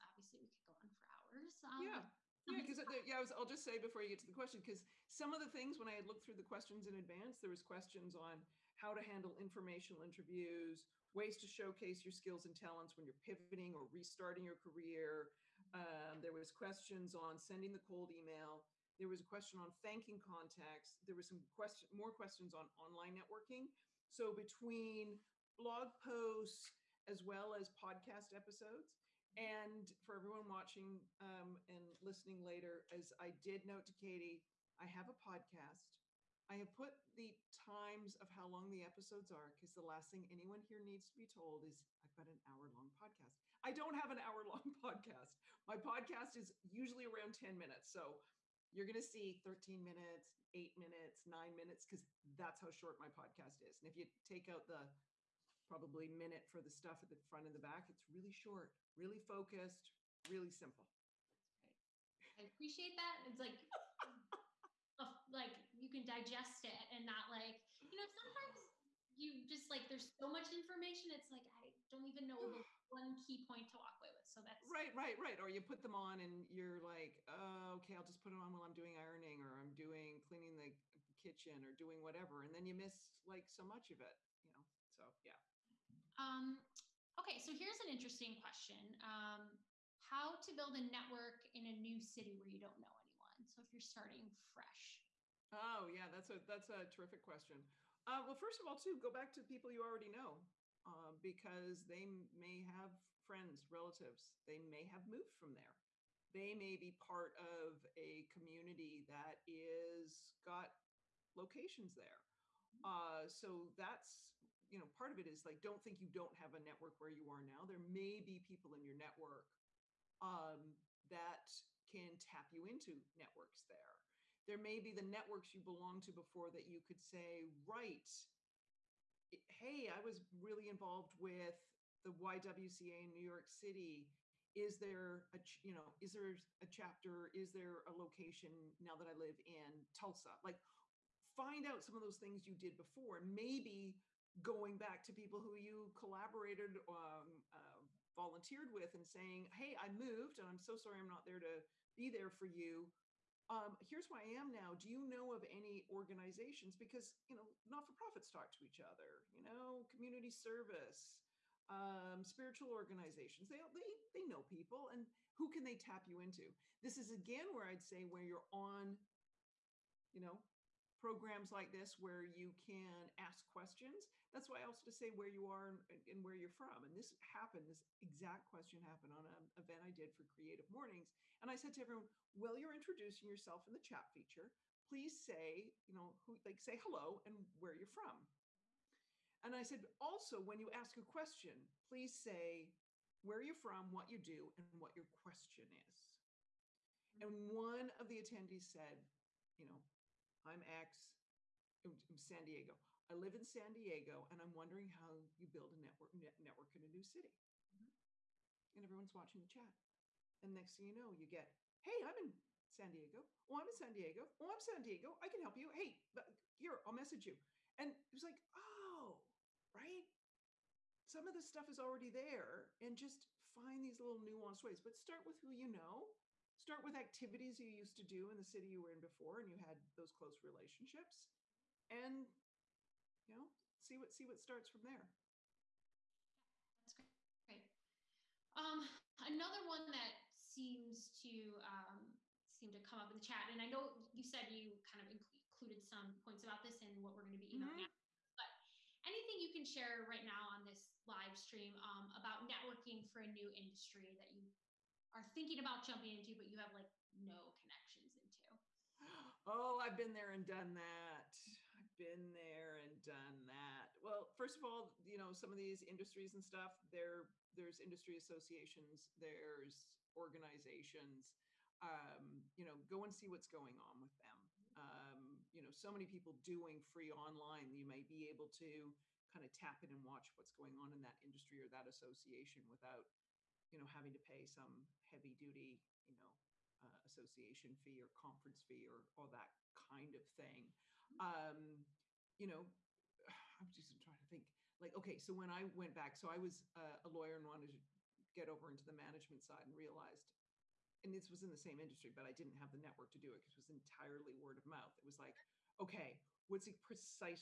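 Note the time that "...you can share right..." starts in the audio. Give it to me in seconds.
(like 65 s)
249 s.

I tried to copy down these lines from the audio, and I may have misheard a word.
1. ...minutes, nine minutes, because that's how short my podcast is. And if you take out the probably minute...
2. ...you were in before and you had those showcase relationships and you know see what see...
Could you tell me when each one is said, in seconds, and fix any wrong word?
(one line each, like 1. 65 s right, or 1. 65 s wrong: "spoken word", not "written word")
1. 50 s right
2. 228 s wrong: "close", not "showcase".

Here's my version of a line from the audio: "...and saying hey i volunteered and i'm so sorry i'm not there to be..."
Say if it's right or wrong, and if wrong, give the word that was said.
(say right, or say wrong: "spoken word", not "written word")
wrong: "moved", not "volunteered".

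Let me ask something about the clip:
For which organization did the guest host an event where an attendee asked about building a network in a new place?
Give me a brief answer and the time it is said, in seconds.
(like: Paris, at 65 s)
Creative Mornings, at 180 s.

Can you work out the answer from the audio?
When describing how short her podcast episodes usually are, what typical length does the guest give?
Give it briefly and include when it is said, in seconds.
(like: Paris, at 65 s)
10 minutes, at 47 s.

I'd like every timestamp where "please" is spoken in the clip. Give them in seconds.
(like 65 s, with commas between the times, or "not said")
184 s, 191 s.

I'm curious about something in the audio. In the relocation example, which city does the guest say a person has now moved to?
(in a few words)
Tulsa.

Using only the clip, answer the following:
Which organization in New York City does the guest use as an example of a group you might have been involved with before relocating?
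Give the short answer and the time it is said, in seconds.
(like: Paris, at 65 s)
YWCA, at 132 s.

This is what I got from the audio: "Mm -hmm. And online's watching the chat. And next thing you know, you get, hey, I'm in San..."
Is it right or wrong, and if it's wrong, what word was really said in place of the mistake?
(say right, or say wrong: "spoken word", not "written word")
wrong: "everyone", not "online".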